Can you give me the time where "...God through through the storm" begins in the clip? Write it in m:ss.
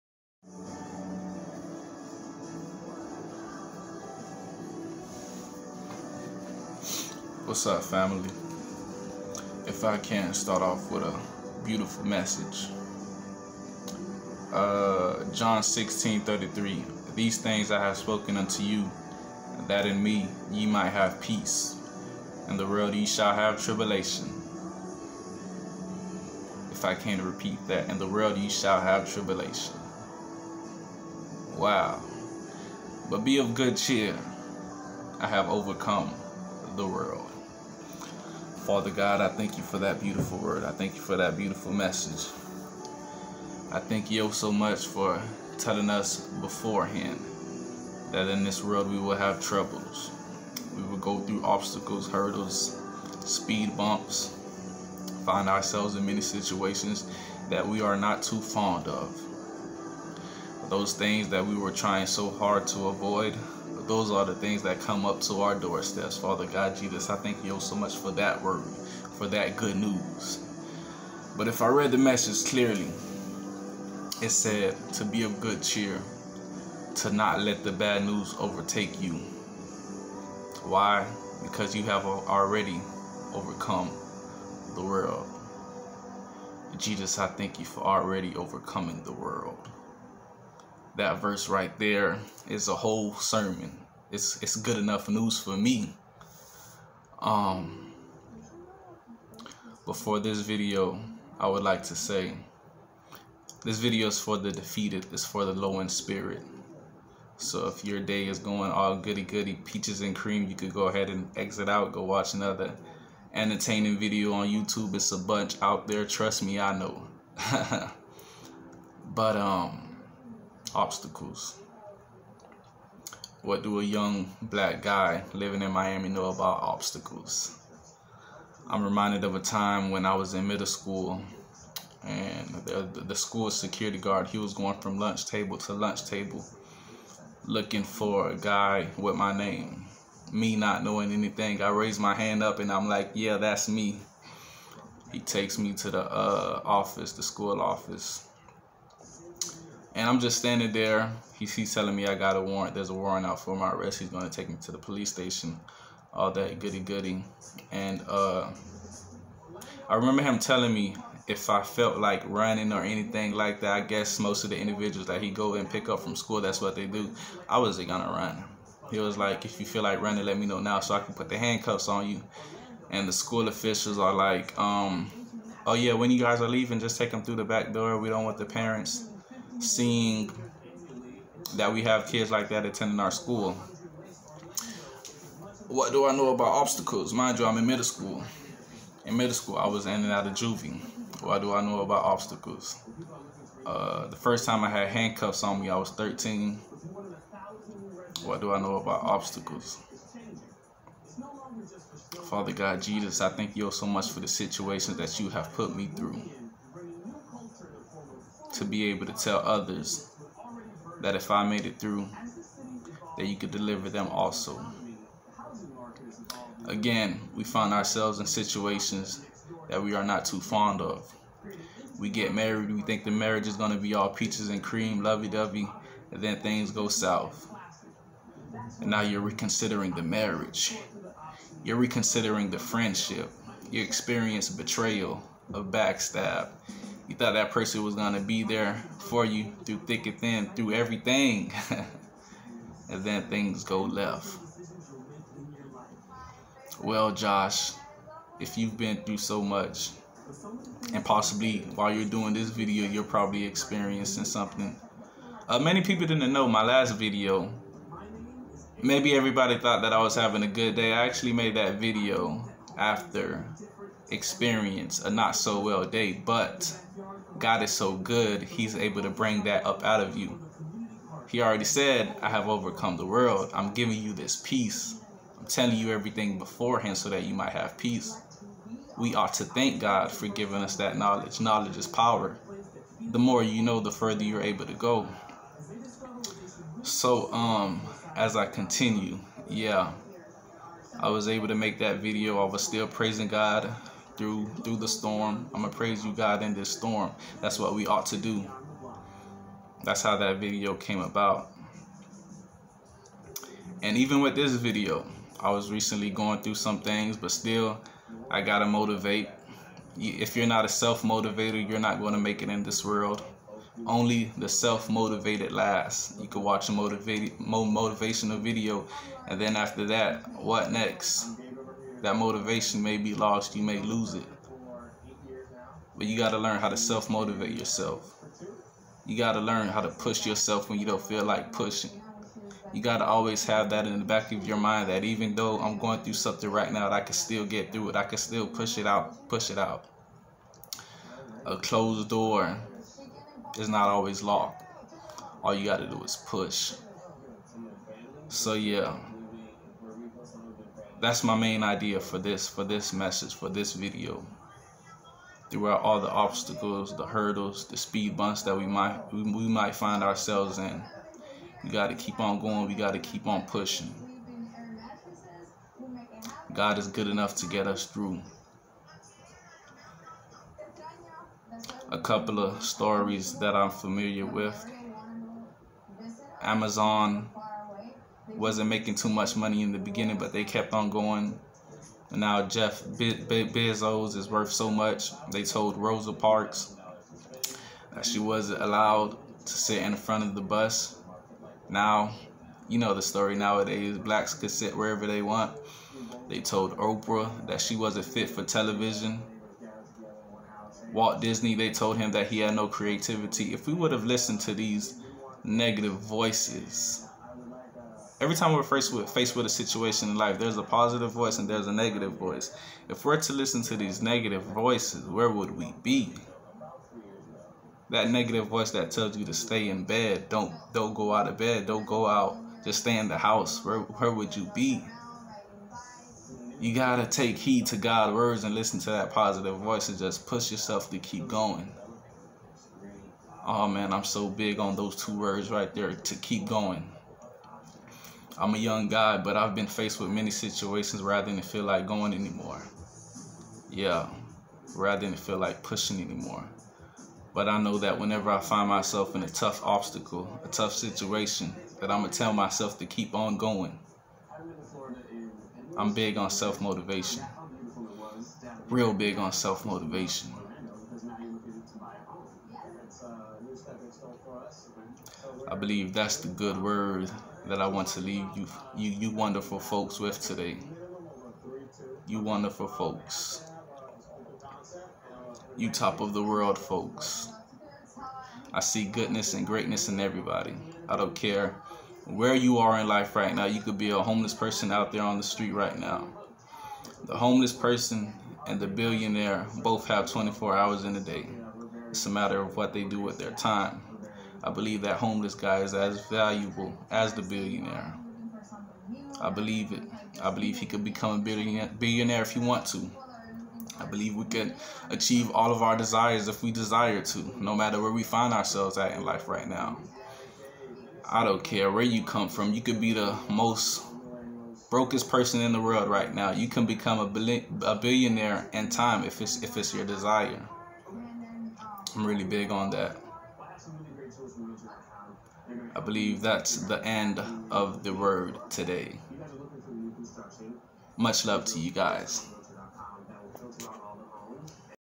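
4:53.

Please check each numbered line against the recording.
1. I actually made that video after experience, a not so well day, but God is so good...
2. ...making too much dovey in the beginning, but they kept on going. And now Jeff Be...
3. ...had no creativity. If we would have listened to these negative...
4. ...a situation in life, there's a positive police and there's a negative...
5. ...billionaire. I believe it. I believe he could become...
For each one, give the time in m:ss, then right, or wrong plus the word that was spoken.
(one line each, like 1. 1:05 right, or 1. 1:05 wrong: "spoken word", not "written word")
1. 4:20 right
2. 6:18 wrong: "money", not "dovey"
3. 6:42 right
4. 6:49 wrong: "voice", not "police"
5. 8:17 right.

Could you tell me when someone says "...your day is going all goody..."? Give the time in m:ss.
1:47.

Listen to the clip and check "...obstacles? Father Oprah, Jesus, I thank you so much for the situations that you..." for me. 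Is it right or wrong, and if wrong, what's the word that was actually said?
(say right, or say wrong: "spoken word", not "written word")
wrong: "God", not "Oprah".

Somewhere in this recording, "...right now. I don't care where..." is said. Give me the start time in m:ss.
8:29.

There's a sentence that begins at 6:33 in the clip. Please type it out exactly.
Blacks could sit wherever they want.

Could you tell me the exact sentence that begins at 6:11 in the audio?
A couple of stories that I'm familiar with.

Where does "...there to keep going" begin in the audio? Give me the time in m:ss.
7:15.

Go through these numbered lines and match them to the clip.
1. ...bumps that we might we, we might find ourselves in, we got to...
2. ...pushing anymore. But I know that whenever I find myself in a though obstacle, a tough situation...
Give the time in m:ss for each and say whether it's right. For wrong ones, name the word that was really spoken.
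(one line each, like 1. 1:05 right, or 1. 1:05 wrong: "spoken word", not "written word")
1. 5:58 right
2. 7:25 wrong: "tough", not "though".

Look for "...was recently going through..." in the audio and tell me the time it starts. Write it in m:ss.
5:05.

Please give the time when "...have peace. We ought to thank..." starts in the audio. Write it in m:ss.
4:37.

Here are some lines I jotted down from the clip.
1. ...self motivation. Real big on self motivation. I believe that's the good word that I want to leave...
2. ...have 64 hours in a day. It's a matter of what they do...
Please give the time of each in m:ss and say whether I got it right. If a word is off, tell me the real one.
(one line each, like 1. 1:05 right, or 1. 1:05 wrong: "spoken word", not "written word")
1. 7:36 right
2. 8:09 wrong: "24", not "64".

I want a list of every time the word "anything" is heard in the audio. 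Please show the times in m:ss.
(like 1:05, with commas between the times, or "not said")
2:21, 2:42.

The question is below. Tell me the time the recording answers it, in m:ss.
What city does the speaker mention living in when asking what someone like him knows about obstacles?
2:05.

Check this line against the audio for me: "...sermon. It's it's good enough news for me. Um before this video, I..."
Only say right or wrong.
right.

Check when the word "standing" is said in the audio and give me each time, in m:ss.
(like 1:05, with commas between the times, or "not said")
2:30.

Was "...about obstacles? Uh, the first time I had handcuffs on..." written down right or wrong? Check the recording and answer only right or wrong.
right.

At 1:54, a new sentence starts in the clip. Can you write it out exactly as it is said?
It's a bunch out there, trust me, I know.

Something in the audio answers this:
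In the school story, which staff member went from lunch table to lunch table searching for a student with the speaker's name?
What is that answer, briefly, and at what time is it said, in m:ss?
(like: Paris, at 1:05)
school security guard, at 2:13.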